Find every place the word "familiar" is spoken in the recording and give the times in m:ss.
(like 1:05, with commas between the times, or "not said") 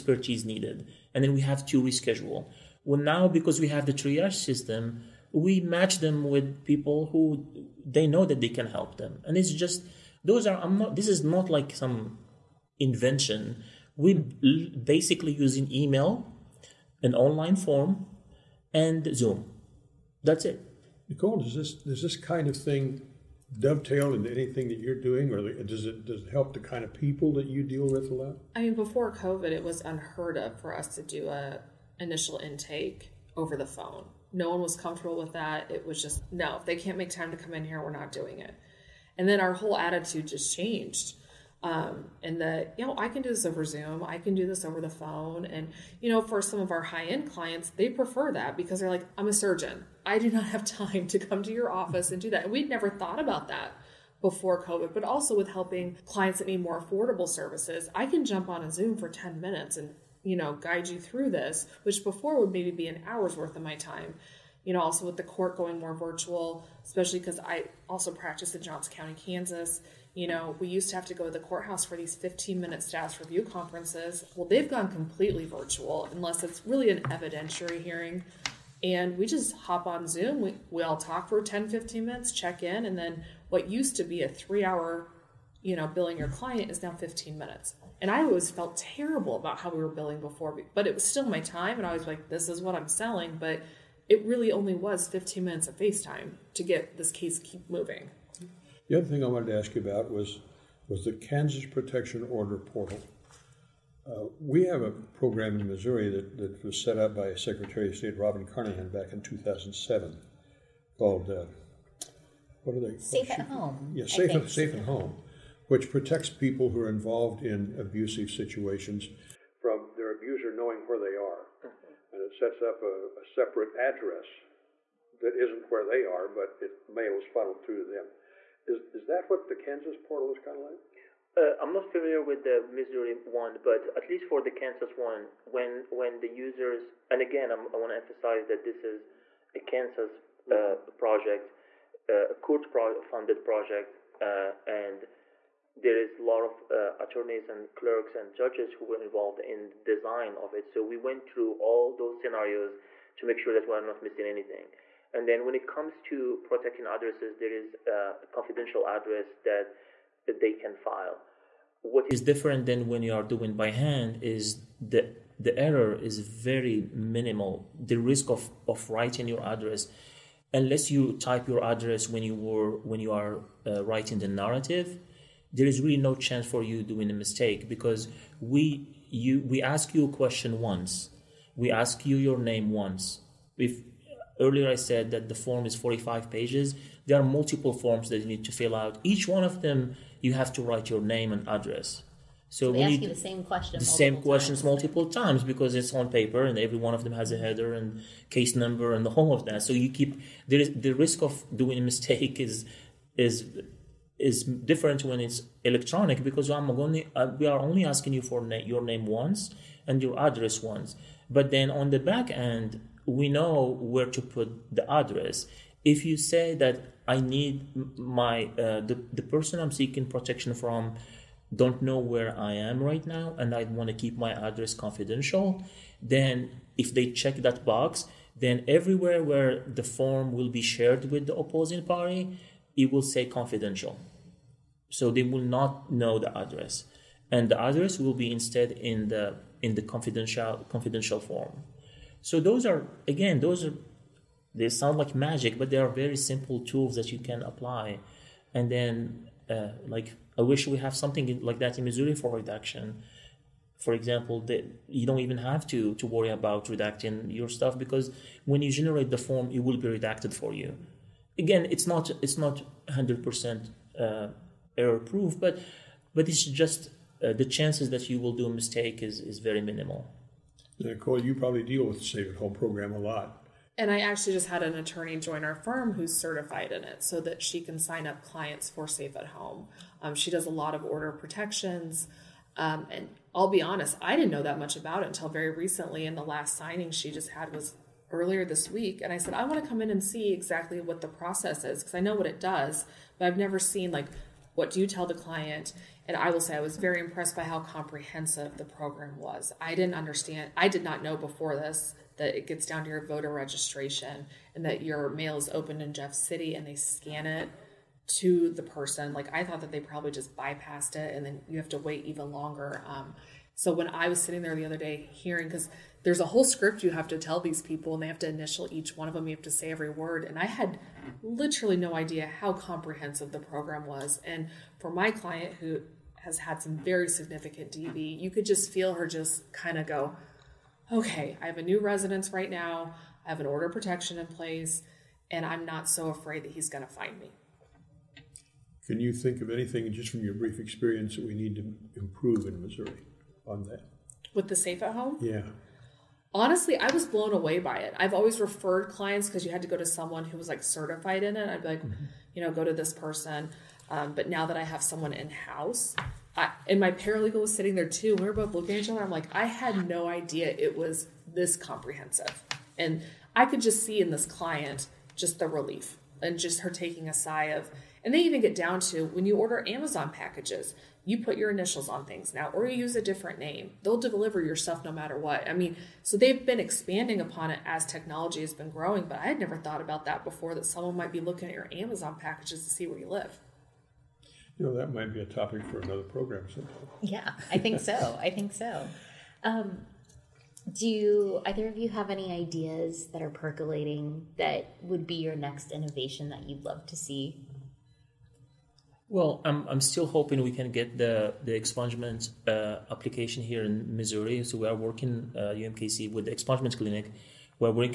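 2:11.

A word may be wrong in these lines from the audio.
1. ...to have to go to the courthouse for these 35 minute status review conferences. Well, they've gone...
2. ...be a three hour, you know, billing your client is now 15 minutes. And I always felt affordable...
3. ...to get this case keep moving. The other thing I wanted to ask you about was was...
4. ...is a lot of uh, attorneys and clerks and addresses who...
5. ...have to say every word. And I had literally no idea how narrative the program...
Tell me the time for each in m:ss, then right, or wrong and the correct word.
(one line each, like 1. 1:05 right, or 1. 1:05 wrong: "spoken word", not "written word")
1. 1:10 wrong: "15", not "35"
2. 1:24 wrong: "terrible", not "affordable"
3. 1:36 right
4. 2:25 wrong: "judges", not "addresses"
5. 5:19 wrong: "comprehensive", not "narrative".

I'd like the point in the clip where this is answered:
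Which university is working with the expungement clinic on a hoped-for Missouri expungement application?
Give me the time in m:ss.
6:45.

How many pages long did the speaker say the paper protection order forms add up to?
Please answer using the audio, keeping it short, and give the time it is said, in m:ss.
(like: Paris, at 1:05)
45, at 3:05.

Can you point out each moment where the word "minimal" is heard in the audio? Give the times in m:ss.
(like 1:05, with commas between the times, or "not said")
2:46, 4:29.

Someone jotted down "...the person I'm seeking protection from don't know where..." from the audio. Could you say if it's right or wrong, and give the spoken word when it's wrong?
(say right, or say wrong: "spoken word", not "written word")
right.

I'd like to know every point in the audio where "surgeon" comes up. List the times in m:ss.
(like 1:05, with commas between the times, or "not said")
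0:49.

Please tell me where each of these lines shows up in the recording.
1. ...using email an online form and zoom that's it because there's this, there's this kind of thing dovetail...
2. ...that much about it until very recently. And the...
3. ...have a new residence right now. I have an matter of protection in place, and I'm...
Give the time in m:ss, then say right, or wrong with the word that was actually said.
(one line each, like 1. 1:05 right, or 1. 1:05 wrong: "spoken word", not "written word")
1. 0:15 right
2. 4:44 right
3. 5:31 wrong: "order", not "matter".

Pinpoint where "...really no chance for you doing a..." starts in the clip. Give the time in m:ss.
2:55.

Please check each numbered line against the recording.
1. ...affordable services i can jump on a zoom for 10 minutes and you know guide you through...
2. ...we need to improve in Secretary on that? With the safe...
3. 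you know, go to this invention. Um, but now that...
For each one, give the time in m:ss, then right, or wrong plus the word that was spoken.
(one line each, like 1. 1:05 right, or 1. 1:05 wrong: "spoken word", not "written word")
1. 0:56 right
2. 5:41 wrong: "Missouri", not "Secretary"
3. 5:52 wrong: "person", not "invention".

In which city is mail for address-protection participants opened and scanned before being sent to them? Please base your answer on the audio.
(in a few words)
Jeff City.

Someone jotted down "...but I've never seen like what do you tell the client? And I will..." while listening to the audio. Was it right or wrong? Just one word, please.
right.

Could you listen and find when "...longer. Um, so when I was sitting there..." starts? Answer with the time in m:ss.
5:12.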